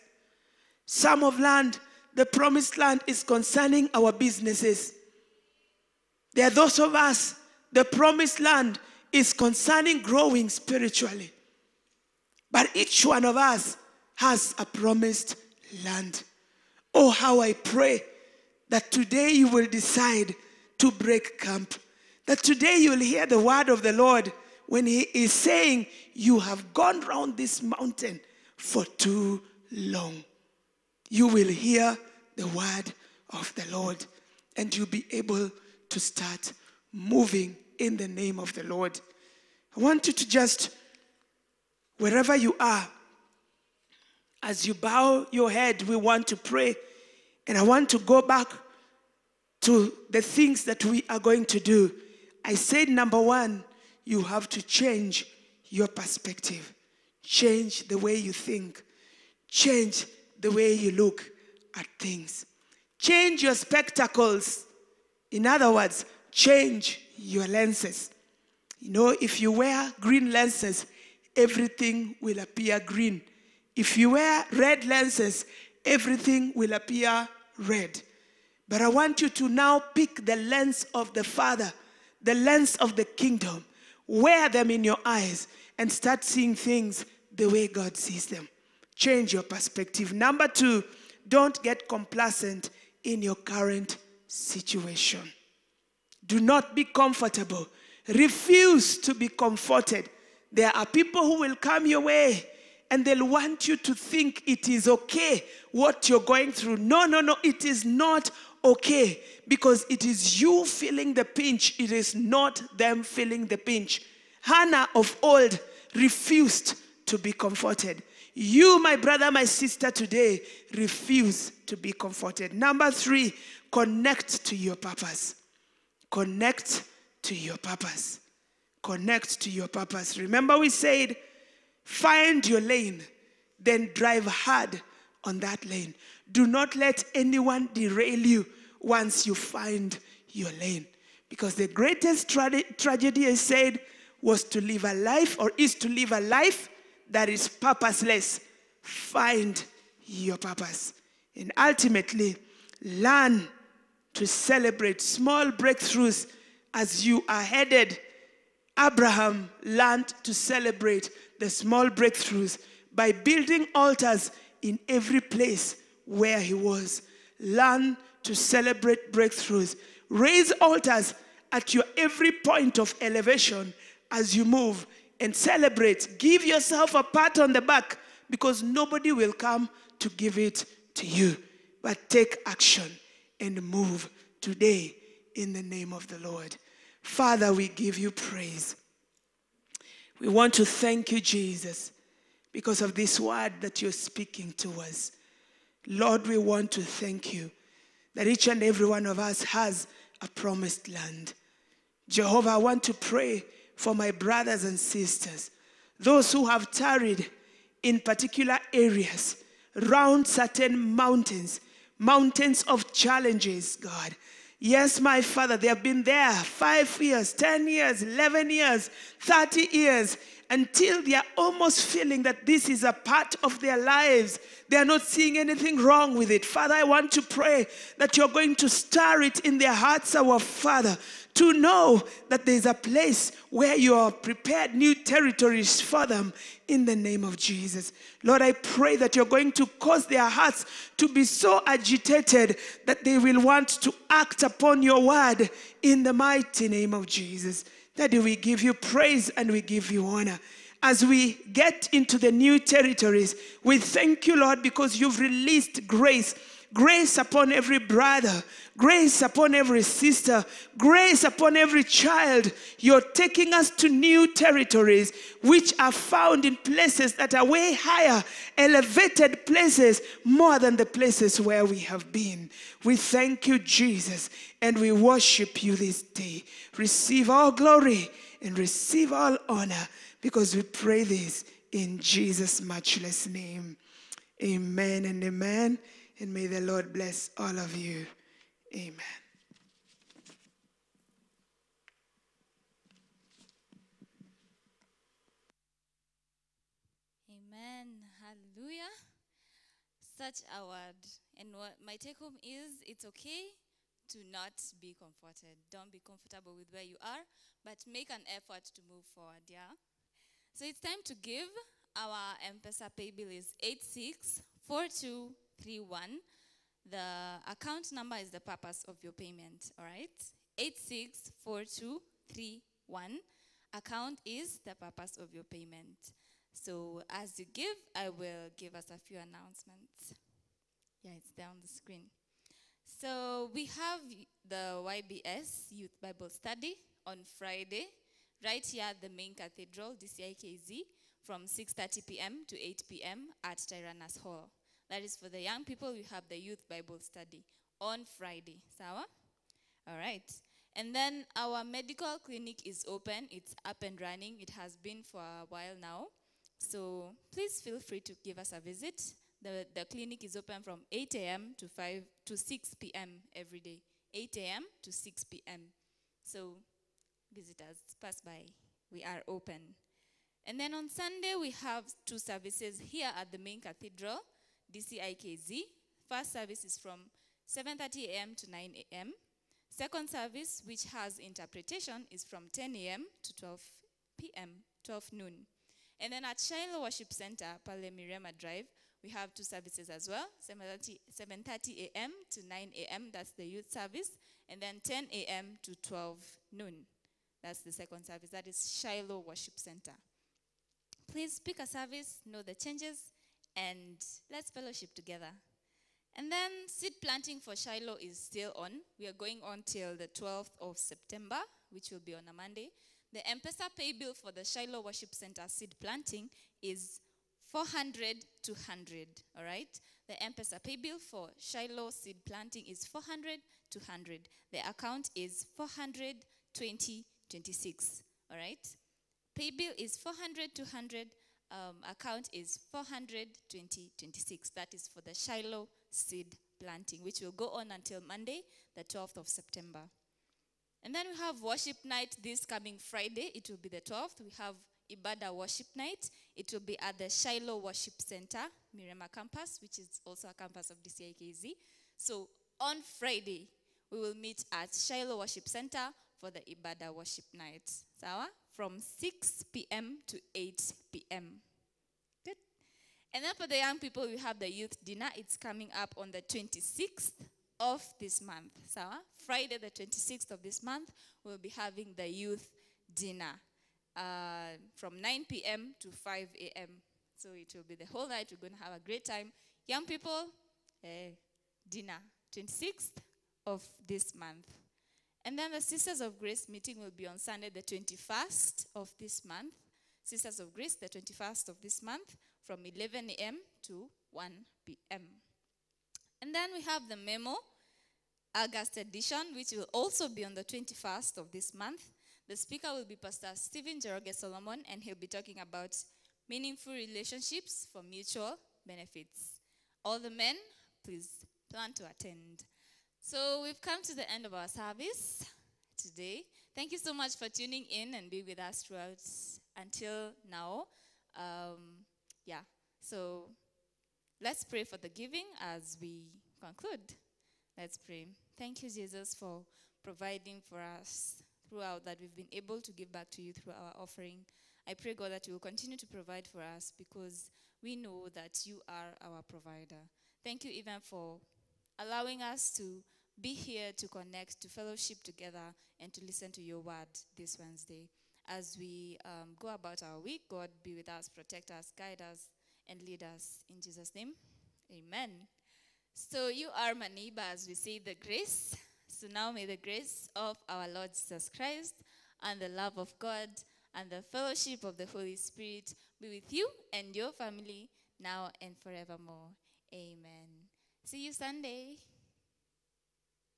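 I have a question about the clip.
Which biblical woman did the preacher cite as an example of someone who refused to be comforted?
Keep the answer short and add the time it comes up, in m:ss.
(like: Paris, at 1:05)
Hannah, at 1:54.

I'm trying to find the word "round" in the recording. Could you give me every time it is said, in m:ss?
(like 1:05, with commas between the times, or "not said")
0:27, 3:29.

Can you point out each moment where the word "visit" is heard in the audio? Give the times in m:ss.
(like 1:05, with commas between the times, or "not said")
5:58, 6:07.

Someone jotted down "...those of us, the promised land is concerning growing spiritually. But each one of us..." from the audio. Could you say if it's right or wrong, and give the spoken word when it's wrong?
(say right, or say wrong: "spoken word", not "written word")
right.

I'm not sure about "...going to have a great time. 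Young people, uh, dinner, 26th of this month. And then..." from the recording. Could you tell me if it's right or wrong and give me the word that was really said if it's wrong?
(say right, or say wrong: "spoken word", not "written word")
right.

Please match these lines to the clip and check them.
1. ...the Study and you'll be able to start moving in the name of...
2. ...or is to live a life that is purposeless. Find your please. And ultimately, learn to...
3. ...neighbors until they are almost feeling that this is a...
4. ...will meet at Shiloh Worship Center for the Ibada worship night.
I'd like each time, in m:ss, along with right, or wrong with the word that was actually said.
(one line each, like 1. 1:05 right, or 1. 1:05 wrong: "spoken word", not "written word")
1. 0:33 wrong: "Lord", not "Study"
2. 2:25 wrong: "purpose", not "please"
3. 3:39 wrong: "years", not "neighbors"
4. 7:33 right.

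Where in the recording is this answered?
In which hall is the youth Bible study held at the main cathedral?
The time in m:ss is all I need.
5:43.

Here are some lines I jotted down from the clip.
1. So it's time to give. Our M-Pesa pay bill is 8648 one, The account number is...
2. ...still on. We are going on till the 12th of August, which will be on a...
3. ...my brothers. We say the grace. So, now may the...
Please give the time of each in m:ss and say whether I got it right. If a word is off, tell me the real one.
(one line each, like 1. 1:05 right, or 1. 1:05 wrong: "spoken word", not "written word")
1. 5:10 wrong: "8642", not "8648"
2. 6:48 wrong: "September", not "August"
3. 9:16 wrong: "neighbors", not "brothers".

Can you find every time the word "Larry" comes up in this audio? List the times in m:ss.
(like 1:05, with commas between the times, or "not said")
not said.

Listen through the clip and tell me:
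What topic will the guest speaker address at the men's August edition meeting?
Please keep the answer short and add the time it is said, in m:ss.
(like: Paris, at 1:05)
Meaningful relationships for mutual benefits, at 8:26.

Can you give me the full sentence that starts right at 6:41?
Please pick a service, know the changes, and let's fellowship together.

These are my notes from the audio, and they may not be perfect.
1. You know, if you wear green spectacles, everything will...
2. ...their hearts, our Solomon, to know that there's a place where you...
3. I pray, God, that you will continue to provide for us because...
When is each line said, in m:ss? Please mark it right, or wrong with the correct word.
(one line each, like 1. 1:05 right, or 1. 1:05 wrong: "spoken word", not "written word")
1. 1:08 wrong: "lenses", not "spectacles"
2. 3:49 wrong: "Father", not "Solomon"
3. 8:54 right.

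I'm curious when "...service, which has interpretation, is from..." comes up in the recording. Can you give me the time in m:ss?
6:20.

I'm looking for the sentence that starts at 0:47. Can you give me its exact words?
And I want to go back to the things that we are going to do.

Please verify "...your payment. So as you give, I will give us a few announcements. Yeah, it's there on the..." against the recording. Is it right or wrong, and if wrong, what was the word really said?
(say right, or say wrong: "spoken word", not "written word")
right.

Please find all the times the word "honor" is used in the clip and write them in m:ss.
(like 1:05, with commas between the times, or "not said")
4:10, 4:39.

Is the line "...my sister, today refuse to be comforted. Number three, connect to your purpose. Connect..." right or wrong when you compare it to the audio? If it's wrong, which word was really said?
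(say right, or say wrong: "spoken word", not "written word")
right.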